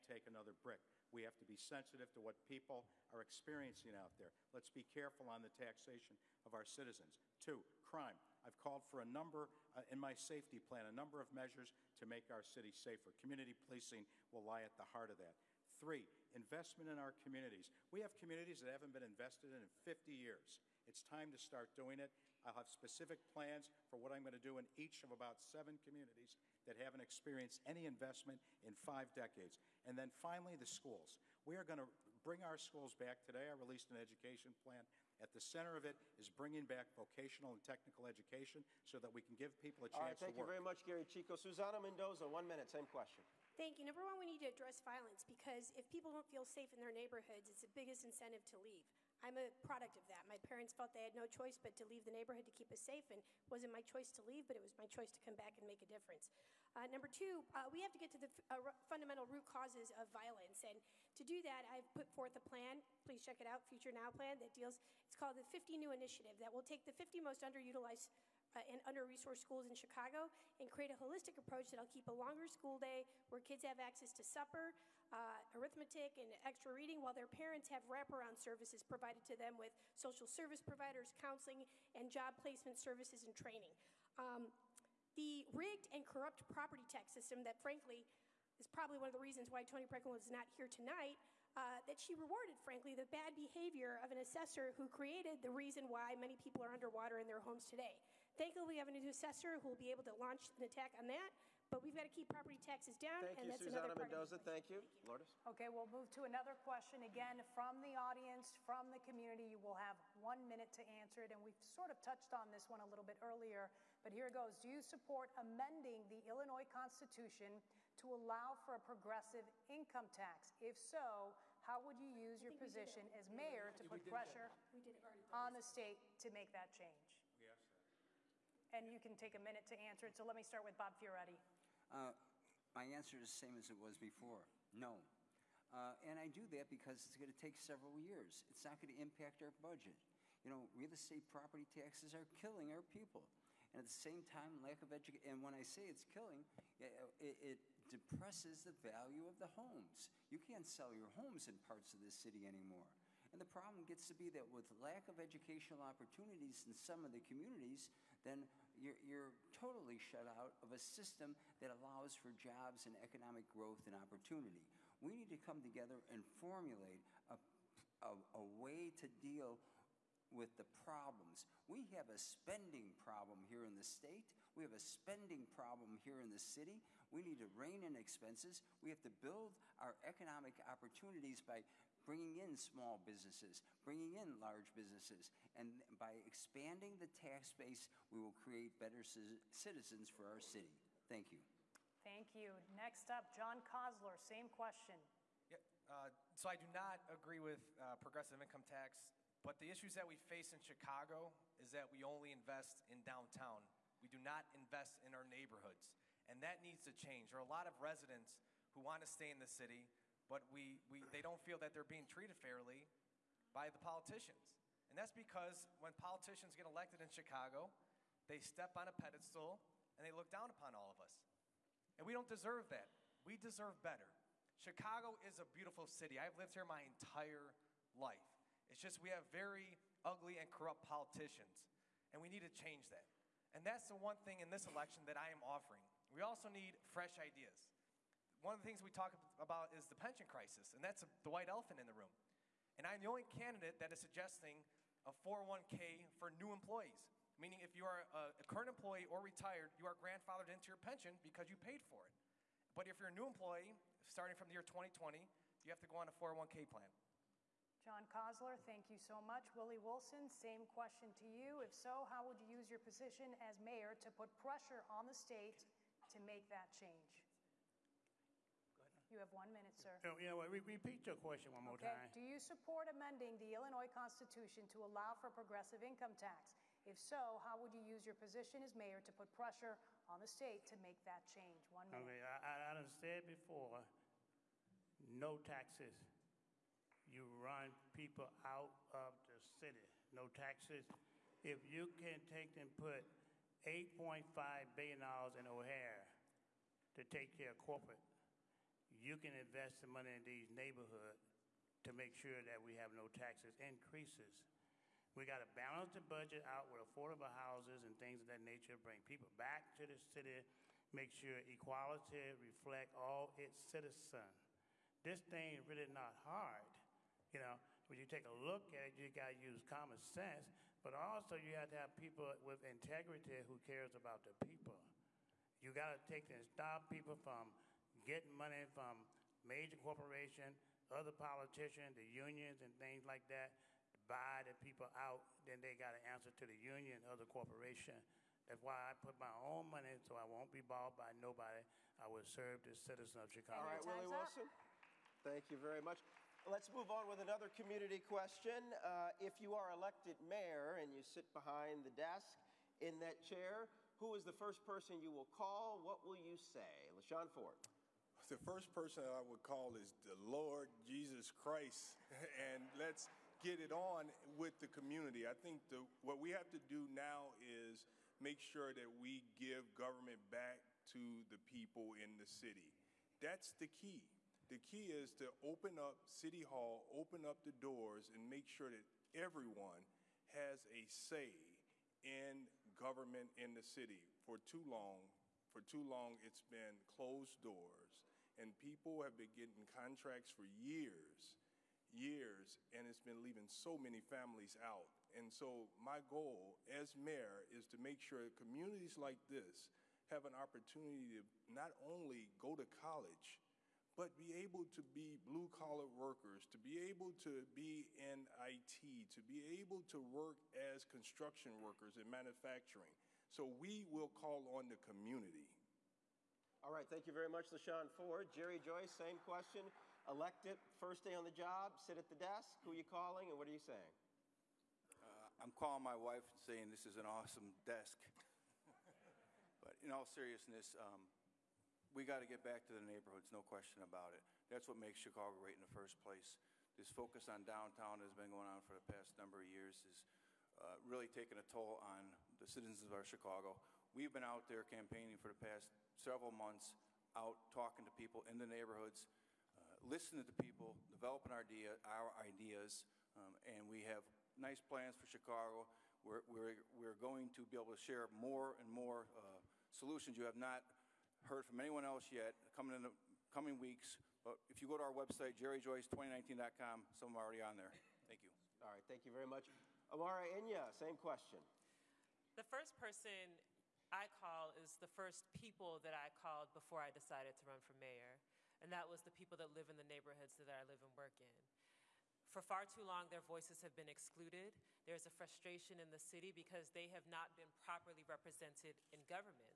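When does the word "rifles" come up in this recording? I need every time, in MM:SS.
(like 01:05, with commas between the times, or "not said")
not said.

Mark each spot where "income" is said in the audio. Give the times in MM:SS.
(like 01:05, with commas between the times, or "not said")
01:59, 03:18, 04:35.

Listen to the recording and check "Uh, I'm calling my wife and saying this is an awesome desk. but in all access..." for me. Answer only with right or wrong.
wrong.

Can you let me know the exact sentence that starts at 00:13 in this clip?
Community policing will lie at the heart of that.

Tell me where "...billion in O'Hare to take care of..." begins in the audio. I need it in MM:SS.
04:54.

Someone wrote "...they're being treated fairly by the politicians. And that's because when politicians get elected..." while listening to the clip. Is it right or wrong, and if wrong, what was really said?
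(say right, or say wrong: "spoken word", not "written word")
right.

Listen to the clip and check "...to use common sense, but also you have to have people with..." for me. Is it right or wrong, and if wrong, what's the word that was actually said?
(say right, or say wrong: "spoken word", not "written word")
right.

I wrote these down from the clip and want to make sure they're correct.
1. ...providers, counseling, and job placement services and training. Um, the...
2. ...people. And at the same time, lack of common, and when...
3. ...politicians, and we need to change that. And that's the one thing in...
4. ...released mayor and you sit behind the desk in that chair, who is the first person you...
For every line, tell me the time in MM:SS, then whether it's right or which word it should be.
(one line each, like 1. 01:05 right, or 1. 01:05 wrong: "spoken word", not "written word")
1. 01:20 right
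2. 02:22 wrong: "education", not "common"
3. 03:50 right
4. 05:49 wrong: "elected", not "released".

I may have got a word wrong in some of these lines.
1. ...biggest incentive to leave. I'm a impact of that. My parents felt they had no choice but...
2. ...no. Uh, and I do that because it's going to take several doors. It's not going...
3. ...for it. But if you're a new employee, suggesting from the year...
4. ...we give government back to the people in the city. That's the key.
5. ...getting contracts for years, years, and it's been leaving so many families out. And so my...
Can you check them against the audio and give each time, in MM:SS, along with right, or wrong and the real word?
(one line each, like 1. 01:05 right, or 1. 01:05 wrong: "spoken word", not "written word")
1. 00:47 wrong: "product", not "impact"
2. 02:14 wrong: "years", not "doors"
3. 04:11 wrong: "starting", not "suggesting"
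4. 06:08 right
5. 06:29 right.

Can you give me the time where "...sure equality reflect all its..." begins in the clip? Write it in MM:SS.
05:11.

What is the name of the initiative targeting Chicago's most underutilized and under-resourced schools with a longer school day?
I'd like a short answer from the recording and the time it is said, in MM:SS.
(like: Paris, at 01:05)
50 New Initiative, at 01:05.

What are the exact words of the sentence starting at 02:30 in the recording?
You can't sell your homes in parts of this city anymore.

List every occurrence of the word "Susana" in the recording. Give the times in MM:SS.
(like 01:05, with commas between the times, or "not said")
00:41, 01:43.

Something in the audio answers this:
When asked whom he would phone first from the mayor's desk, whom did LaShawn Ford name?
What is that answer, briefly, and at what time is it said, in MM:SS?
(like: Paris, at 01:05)
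Lord Jesus Christ, at 06:00.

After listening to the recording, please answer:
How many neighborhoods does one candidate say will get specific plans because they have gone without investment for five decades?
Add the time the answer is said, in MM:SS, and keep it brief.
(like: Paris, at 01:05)
7, at 00:25.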